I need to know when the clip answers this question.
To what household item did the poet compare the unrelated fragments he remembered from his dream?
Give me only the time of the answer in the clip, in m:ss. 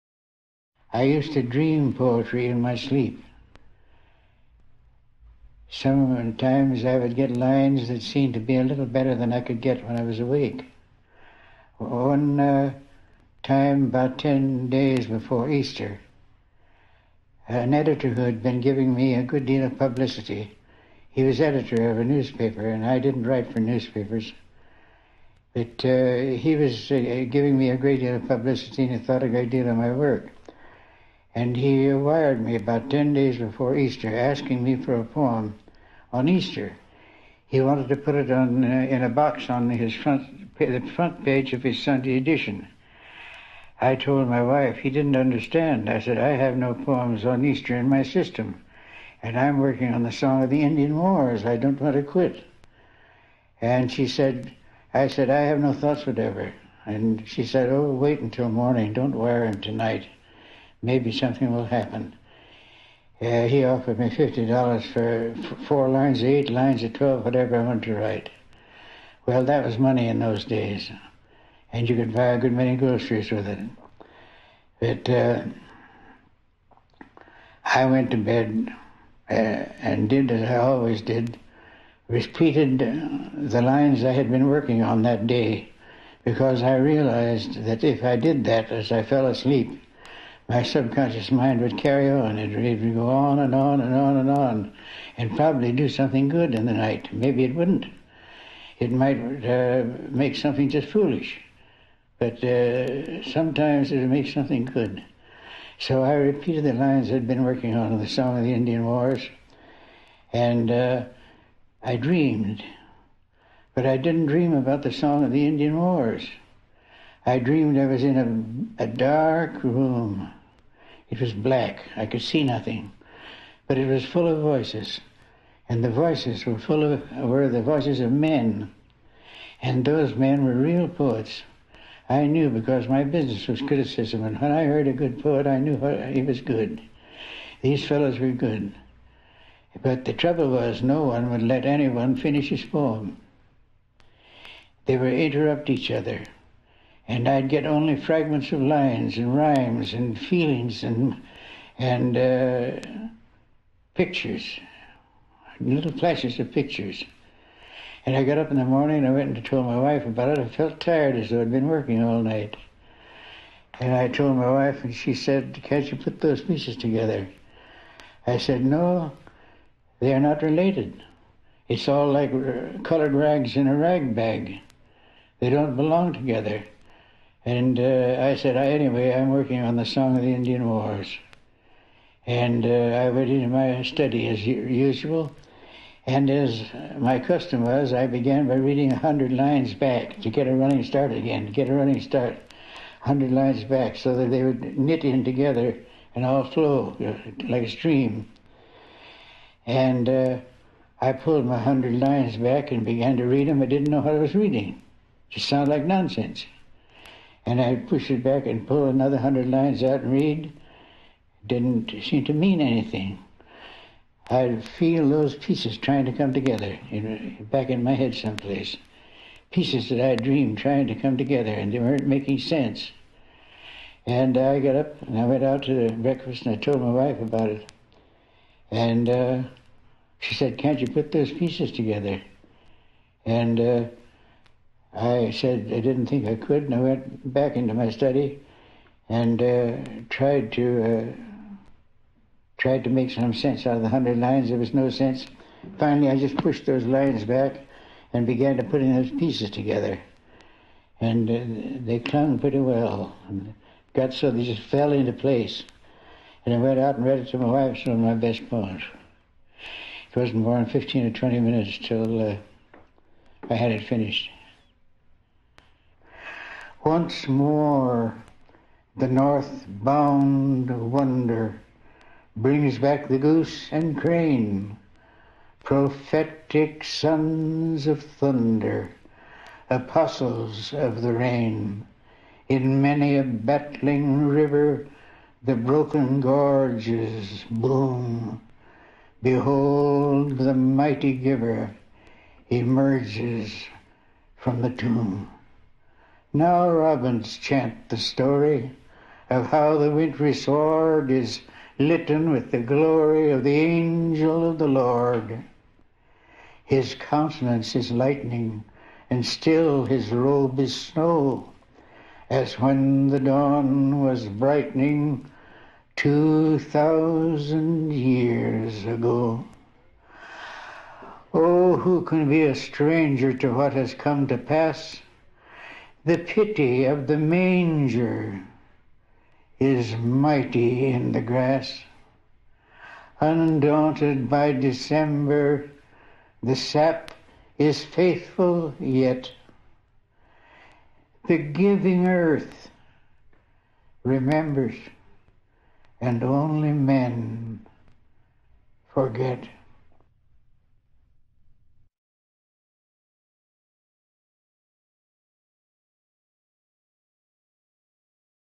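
2:53.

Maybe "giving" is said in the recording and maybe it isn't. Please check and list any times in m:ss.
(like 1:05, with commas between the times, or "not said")
0:18, 0:27, 5:41.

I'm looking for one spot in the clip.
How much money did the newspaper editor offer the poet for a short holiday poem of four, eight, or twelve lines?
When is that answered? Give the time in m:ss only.
1:04.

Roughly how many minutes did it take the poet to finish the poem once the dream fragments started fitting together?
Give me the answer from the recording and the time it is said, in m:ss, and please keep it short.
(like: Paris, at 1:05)
15 or 20, at 4:20.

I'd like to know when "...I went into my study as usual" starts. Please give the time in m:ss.
3:02.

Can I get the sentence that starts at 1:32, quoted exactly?
It would go on and on and on and on, and probably do something good in the night.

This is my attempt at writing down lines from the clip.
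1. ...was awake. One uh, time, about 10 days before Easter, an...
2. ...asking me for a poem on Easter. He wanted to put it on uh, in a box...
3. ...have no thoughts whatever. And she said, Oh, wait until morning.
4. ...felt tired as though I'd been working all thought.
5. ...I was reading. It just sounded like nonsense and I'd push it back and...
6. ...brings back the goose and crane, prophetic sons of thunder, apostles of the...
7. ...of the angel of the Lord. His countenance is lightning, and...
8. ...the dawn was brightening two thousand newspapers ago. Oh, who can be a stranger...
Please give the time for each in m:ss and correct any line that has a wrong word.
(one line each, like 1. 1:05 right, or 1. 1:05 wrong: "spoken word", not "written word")
1. 0:10 right
2. 0:34 right
3. 0:55 right
4. 2:40 wrong: "night", not "thought"
5. 3:24 right
6. 4:32 right
7. 5:03 right
8. 5:13 wrong: "years", not "newspapers".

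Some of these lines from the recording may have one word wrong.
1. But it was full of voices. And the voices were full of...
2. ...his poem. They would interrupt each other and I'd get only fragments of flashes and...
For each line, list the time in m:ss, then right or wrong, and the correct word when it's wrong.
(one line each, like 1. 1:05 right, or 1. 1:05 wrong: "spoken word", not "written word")
1. 2:03 right
2. 2:22 wrong: "lines", not "flashes".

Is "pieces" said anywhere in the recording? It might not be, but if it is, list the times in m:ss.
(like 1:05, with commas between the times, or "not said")
2:46, 3:35, 3:39, 3:51, 4:09.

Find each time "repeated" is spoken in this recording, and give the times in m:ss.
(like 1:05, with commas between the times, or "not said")
1:22, 1:46.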